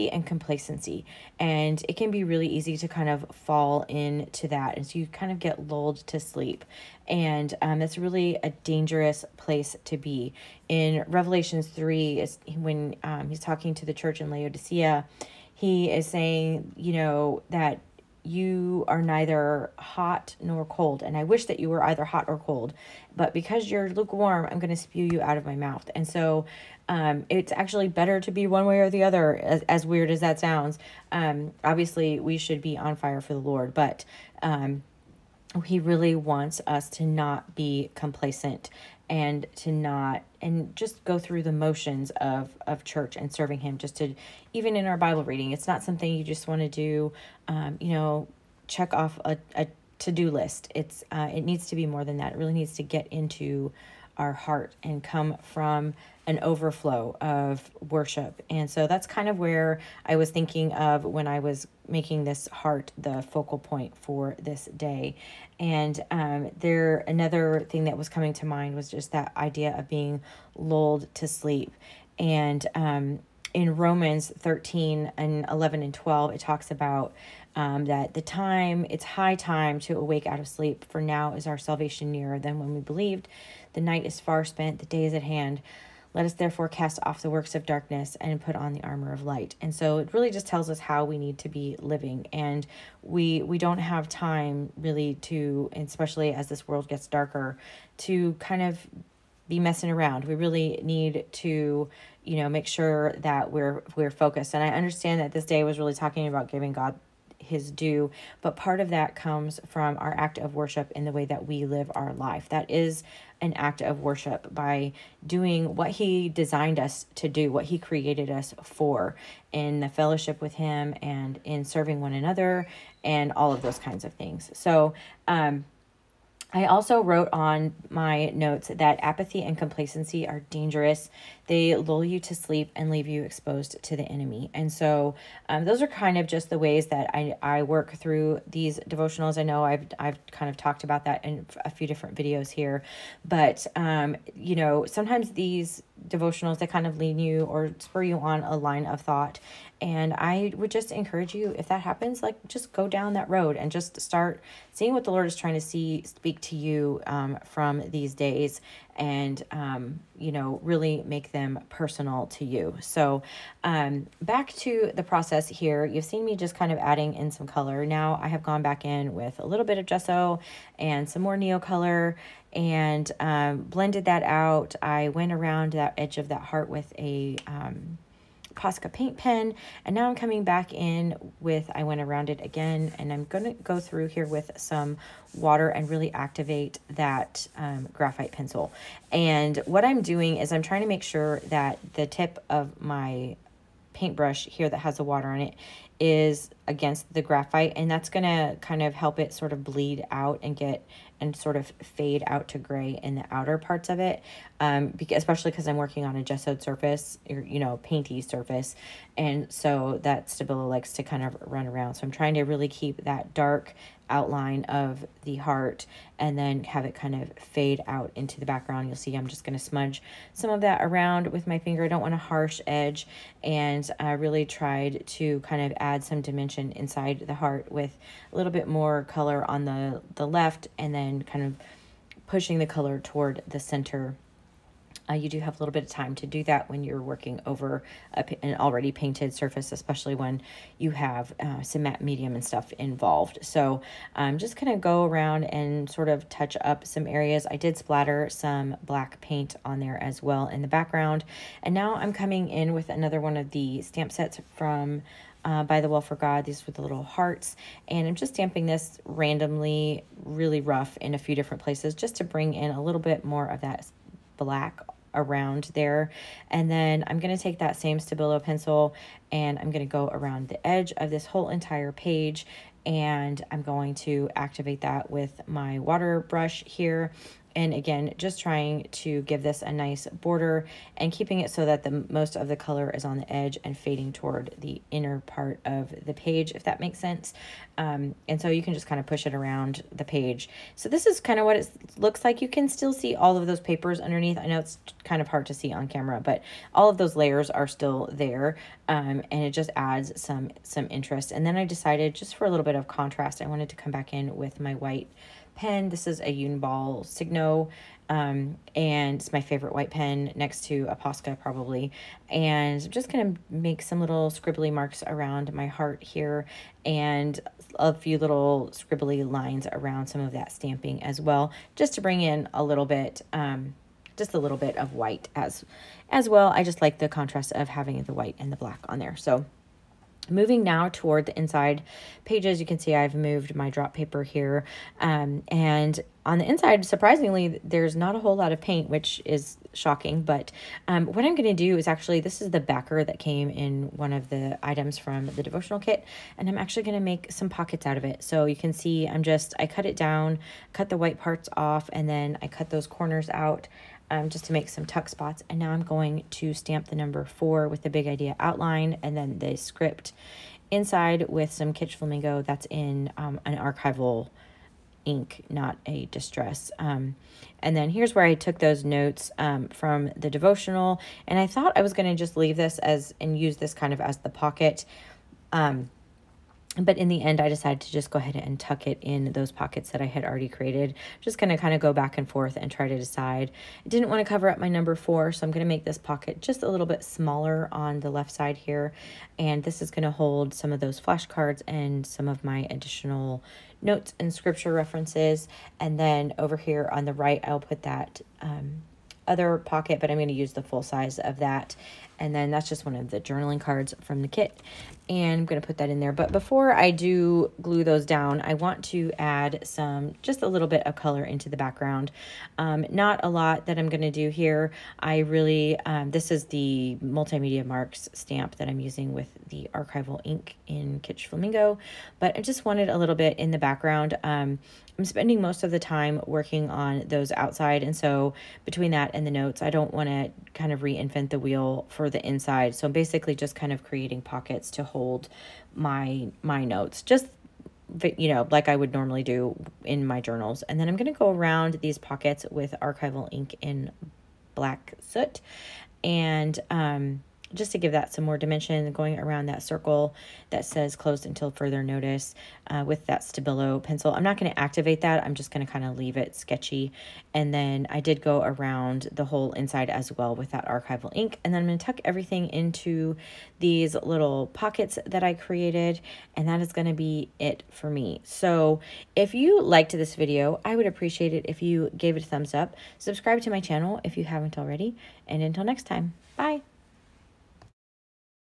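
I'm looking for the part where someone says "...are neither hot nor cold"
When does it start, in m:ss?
0:18.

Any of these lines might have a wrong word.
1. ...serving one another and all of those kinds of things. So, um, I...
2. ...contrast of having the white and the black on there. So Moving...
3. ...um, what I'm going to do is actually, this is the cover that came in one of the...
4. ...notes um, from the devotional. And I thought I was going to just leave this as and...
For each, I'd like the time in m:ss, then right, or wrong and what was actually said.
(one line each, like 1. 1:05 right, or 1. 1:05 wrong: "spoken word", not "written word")
1. 2:01 right
2. 5:27 right
3. 5:40 wrong: "backer", not "cover"
4. 6:08 right.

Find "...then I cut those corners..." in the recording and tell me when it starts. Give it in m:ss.
5:52.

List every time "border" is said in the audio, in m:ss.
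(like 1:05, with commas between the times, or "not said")
4:40.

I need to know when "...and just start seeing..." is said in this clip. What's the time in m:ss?
2:33.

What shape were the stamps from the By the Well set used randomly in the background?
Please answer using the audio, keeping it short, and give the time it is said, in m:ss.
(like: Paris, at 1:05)
little hearts, at 4:16.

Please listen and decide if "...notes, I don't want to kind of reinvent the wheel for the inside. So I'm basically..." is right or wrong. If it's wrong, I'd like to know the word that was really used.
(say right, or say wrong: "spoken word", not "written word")
right.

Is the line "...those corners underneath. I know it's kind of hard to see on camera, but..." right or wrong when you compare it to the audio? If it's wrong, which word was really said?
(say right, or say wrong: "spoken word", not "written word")
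wrong: "papers", not "corners".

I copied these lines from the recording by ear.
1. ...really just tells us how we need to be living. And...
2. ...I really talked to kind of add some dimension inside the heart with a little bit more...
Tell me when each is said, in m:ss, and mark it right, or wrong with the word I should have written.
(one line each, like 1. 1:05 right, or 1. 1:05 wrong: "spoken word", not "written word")
1. 1:30 right
2. 3:43 wrong: "tried", not "talked".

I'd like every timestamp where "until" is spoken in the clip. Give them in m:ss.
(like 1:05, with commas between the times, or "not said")
7:31, 7:55.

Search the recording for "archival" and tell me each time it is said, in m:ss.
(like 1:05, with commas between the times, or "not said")
6:03, 6:59, 7:22, 7:40.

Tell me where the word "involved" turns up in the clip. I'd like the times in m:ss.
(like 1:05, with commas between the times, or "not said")
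4:02.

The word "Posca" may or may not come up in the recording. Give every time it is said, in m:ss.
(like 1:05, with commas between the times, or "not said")
2:58, 5:10.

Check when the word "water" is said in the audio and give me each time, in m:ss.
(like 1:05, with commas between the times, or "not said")
3:05, 3:15, 4:35.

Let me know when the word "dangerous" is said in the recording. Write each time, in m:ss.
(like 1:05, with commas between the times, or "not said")
0:08, 2:10.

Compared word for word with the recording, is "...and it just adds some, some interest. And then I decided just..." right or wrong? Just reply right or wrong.
right.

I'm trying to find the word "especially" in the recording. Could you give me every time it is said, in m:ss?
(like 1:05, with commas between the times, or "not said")
1:35, 3:25, 3:59.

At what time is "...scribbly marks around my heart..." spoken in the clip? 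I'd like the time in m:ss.
5:14.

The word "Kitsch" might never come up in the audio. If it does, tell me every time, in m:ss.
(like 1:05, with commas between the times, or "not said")
6:01, 7:00.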